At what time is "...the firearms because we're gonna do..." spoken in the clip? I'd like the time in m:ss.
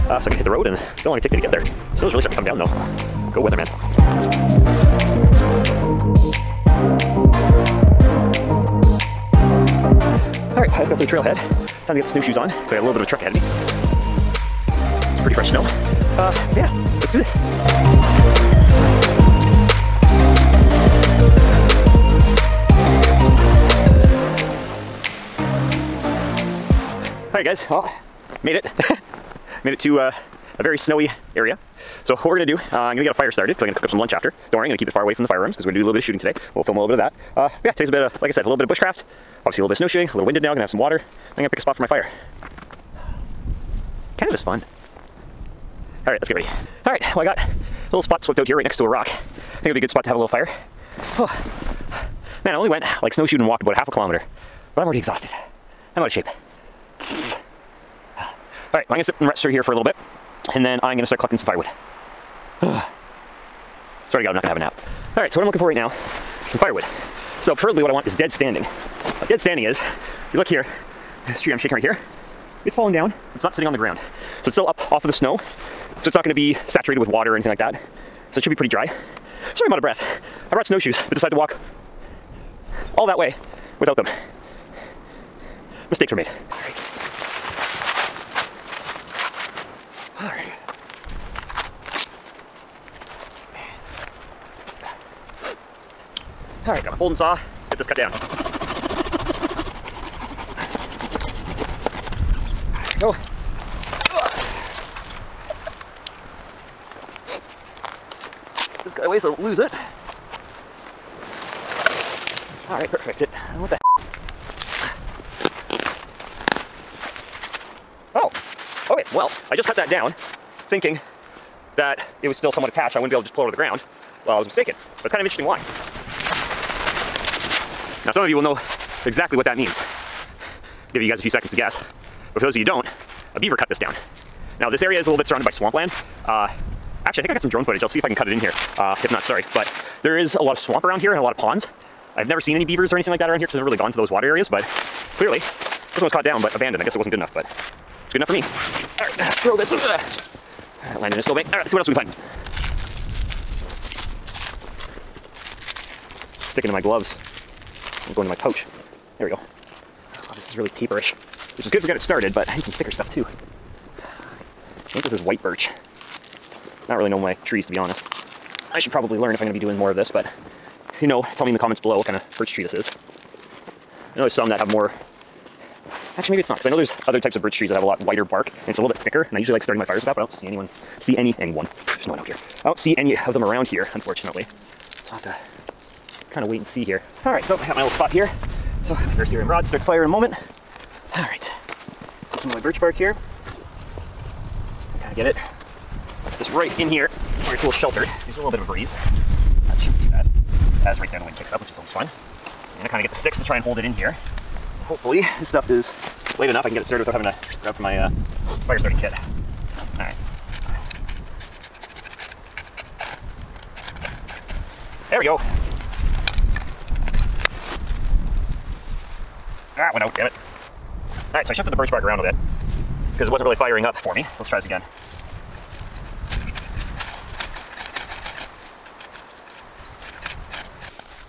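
0:35.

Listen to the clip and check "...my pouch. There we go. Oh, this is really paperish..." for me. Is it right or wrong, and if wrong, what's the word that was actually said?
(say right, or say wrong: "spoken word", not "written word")
right.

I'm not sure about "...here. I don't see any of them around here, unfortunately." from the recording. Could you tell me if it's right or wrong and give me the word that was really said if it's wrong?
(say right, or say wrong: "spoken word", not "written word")
right.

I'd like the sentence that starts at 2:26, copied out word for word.
I guess it wasn't good enough, but it's good enough for me.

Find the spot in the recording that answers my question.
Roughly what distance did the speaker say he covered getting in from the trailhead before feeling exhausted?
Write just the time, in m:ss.
0:53.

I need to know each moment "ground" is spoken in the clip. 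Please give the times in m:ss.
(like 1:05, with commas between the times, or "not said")
1:13, 2:03.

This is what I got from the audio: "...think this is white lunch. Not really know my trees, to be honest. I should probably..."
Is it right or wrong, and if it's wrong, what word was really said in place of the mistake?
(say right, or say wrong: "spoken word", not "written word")
wrong: "birch", not "lunch".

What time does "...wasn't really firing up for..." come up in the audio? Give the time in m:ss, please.
3:43.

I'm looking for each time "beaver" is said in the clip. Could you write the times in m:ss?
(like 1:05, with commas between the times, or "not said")
2:13, 2:22.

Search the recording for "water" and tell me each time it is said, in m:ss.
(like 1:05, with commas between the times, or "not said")
0:40, 1:17, 2:24.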